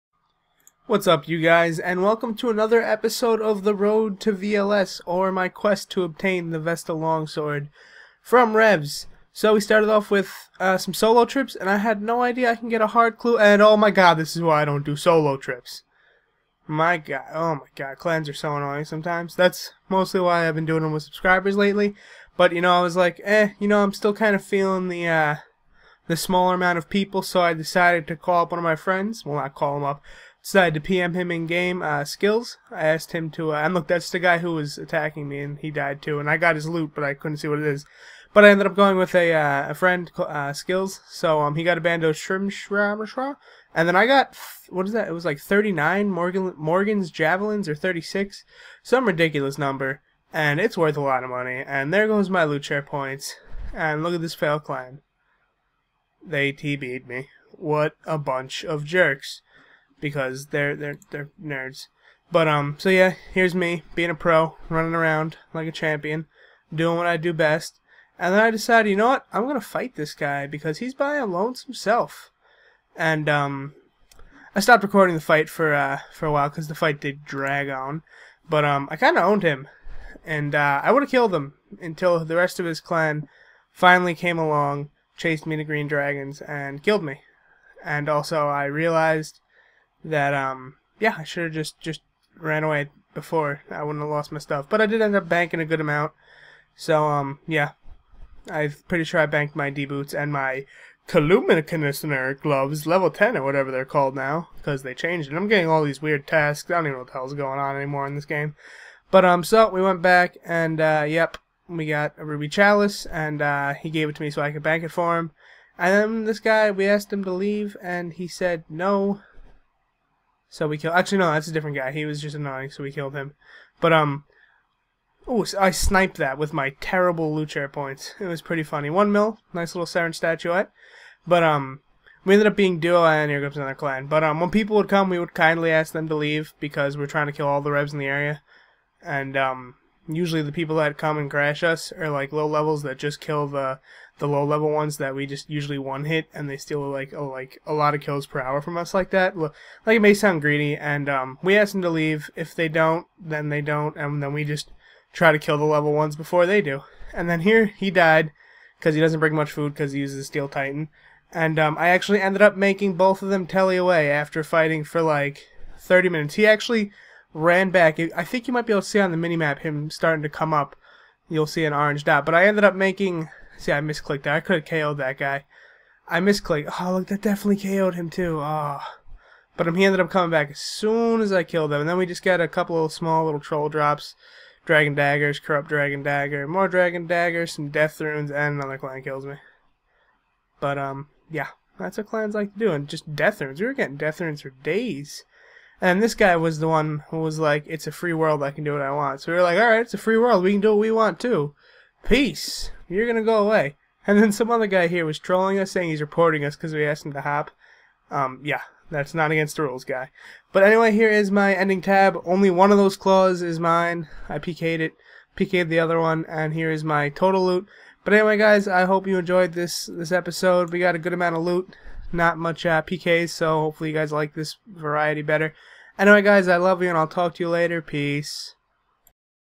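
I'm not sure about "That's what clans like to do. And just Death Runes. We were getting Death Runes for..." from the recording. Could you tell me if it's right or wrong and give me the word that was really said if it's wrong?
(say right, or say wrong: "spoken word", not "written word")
right.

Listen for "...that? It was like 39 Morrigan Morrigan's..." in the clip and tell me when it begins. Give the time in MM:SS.
00:44.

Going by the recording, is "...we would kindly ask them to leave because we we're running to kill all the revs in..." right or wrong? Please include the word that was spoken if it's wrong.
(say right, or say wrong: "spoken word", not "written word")
wrong: "trying", not "running".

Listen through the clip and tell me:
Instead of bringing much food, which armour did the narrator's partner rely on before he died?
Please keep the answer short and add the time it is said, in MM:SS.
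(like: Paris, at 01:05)
Steel Titan, at 02:40.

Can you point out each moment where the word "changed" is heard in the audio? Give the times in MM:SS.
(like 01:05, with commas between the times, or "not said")
01:44.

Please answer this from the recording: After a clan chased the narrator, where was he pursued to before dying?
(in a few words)
Green Dragons.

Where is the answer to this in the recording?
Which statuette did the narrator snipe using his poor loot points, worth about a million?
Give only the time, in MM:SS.
02:09.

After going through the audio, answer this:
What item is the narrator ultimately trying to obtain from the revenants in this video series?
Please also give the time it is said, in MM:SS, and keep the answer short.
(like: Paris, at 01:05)
Vesta Longsword, at 00:06.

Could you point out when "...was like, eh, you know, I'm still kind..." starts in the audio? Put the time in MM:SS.
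00:22.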